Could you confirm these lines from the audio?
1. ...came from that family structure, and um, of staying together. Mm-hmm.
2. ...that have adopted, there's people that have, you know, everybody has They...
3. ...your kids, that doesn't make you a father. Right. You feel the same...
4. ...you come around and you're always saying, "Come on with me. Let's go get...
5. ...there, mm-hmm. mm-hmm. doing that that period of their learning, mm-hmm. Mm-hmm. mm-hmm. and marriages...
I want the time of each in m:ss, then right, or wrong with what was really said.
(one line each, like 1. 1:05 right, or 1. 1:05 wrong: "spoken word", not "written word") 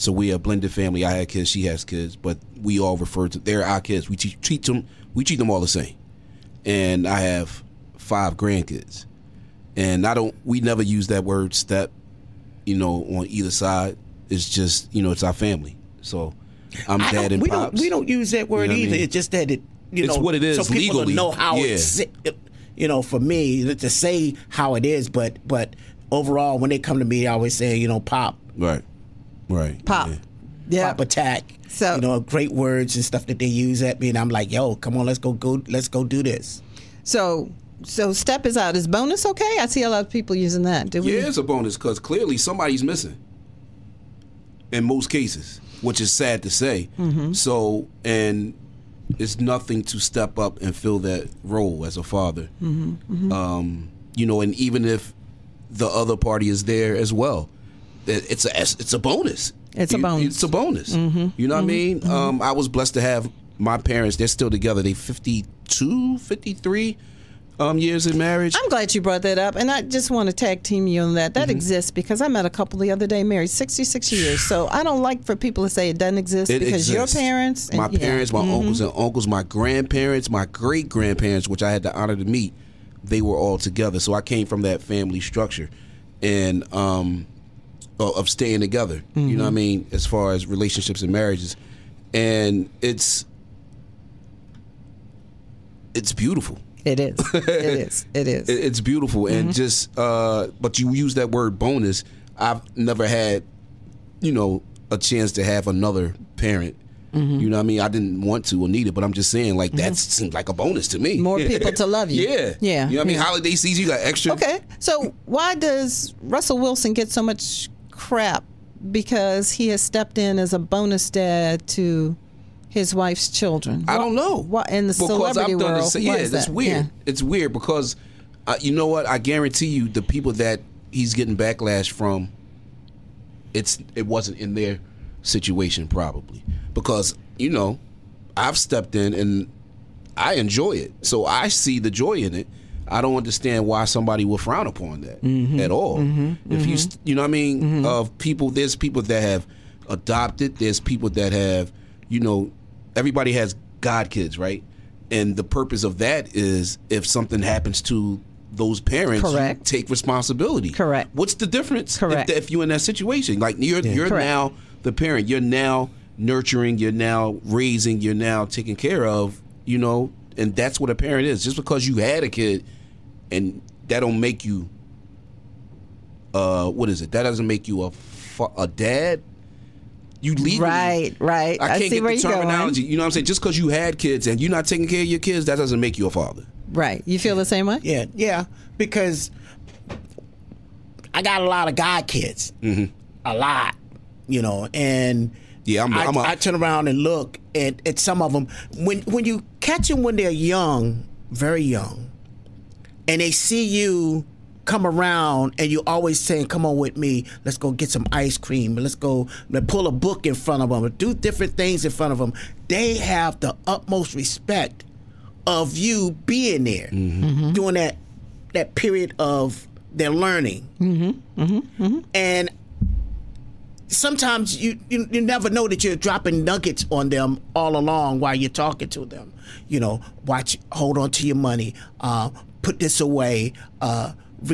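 1. 1:24 right
2. 2:29 wrong: "God", not "They"
3. 3:05 right
4. 3:23 right
5. 3:36 wrong: "sometimes", not "marriages".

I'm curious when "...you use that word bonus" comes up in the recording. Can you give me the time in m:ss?
1:40.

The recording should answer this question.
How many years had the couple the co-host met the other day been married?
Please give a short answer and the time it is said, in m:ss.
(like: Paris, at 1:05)
66 years, at 1:13.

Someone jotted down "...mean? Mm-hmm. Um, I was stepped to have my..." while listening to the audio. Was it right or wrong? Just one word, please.
wrong.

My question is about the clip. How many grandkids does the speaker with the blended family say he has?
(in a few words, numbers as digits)
5.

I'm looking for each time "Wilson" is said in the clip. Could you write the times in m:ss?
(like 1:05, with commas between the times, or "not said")
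1:56.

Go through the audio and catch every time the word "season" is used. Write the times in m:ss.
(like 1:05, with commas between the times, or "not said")
1:53.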